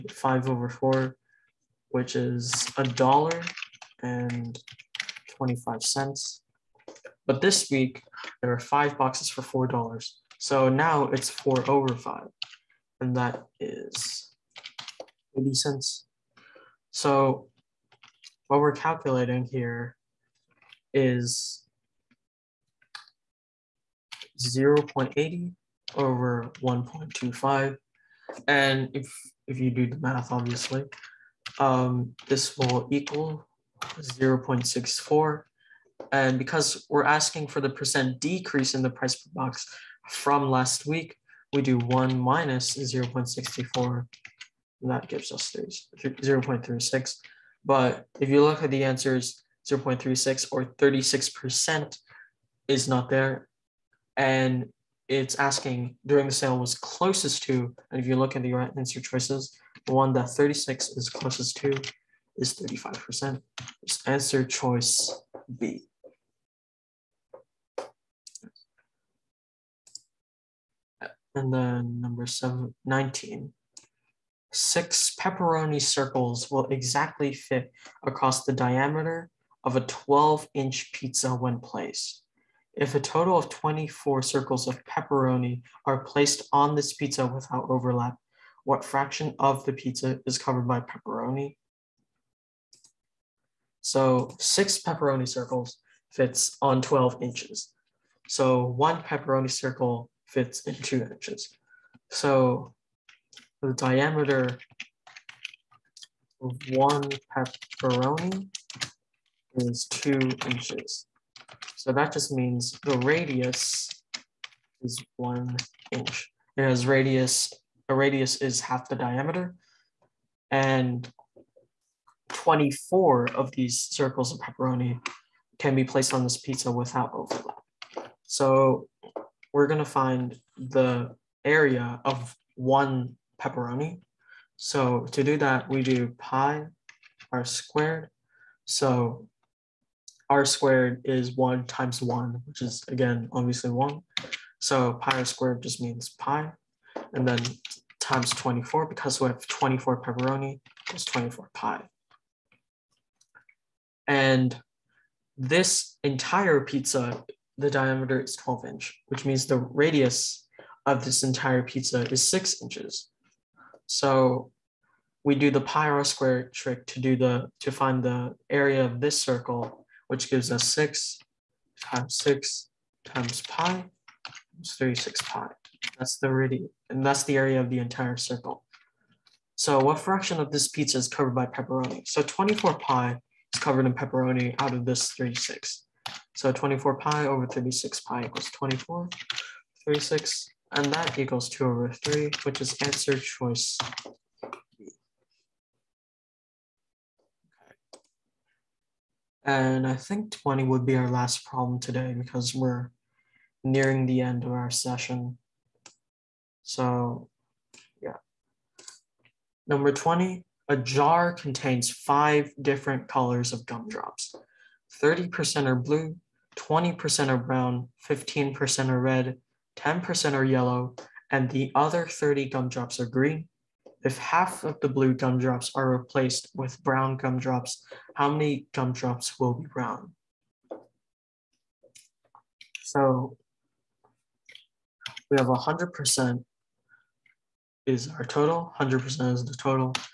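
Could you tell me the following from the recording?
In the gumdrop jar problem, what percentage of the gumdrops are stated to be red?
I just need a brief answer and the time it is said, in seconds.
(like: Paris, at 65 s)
15%, at 218 s.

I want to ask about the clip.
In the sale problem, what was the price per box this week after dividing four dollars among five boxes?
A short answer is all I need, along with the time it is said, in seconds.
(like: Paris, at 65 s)
80 cents, at 15 s.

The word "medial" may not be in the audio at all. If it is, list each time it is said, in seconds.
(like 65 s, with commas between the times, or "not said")
not said.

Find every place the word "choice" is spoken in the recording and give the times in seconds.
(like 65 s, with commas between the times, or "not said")
59 s, 64 s, 193 s.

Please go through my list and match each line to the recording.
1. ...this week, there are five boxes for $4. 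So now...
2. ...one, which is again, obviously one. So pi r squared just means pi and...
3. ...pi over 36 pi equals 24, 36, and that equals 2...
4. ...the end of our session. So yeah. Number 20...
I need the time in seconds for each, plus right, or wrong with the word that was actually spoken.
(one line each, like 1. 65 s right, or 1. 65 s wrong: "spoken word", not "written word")
1. 7 s right
2. 142 s right
3. 186 s right
4. 204 s right.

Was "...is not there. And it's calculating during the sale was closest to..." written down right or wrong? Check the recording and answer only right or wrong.
wrong.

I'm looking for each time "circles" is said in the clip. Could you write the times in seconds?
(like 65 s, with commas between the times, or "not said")
75 s, 84 s, 95 s, 99 s, 123 s, 169 s, 178 s.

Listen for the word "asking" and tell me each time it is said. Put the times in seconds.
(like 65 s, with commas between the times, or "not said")
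37 s, 55 s.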